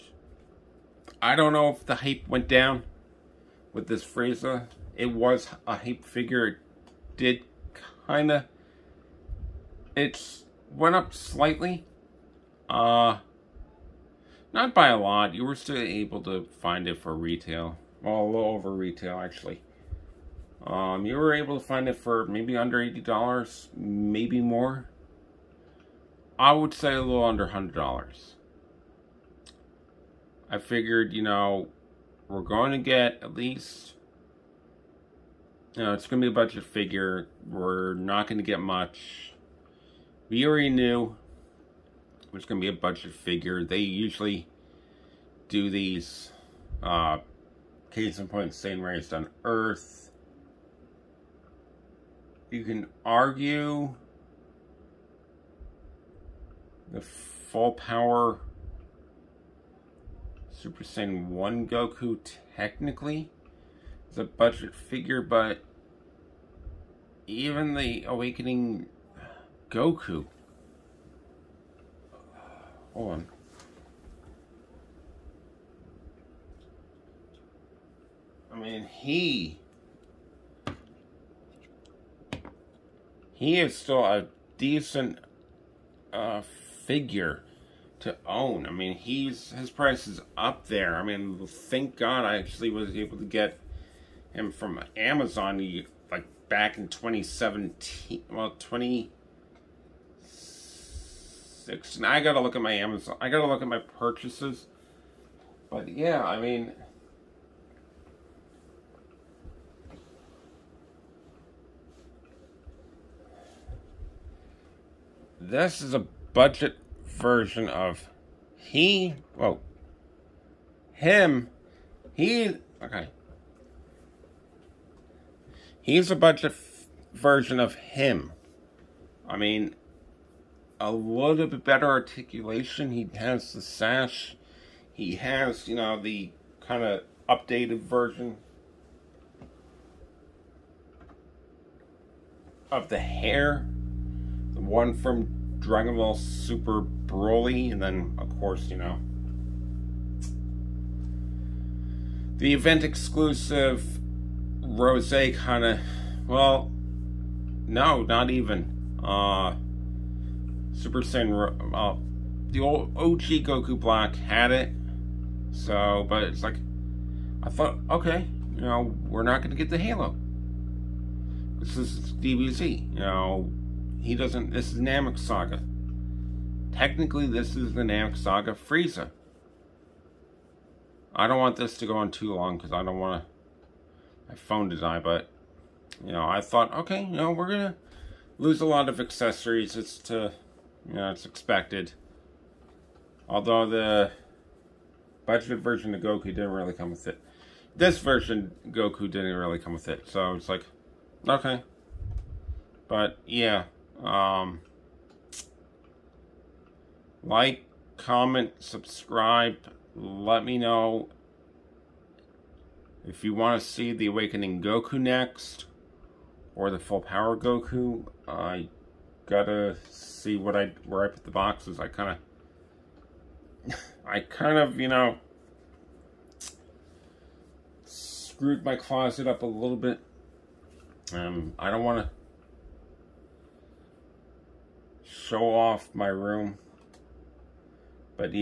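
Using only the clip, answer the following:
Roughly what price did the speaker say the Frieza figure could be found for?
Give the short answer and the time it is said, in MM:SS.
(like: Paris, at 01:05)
$80, at 00:22.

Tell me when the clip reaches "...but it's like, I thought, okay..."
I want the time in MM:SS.
02:46.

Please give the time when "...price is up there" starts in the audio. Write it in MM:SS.
01:29.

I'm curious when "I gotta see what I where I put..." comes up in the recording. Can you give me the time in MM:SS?
03:38.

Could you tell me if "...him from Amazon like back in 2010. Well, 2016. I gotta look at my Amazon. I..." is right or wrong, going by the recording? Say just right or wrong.
wrong.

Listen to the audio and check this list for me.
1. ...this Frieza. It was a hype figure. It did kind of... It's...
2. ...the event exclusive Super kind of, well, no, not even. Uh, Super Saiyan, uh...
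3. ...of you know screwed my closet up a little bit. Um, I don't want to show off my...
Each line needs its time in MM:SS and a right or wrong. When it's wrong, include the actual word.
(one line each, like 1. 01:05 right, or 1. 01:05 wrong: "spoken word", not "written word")
1. 00:03 right
2. 02:32 wrong: "Rose", not "Super"
3. 03:44 right.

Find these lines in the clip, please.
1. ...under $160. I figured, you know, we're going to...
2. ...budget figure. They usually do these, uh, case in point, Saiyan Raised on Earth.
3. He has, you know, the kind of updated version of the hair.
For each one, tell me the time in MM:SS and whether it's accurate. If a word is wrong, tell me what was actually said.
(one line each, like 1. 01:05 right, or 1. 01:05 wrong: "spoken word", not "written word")
1. 00:27 wrong: "100", not "160"
2. 00:42 right
3. 02:14 right.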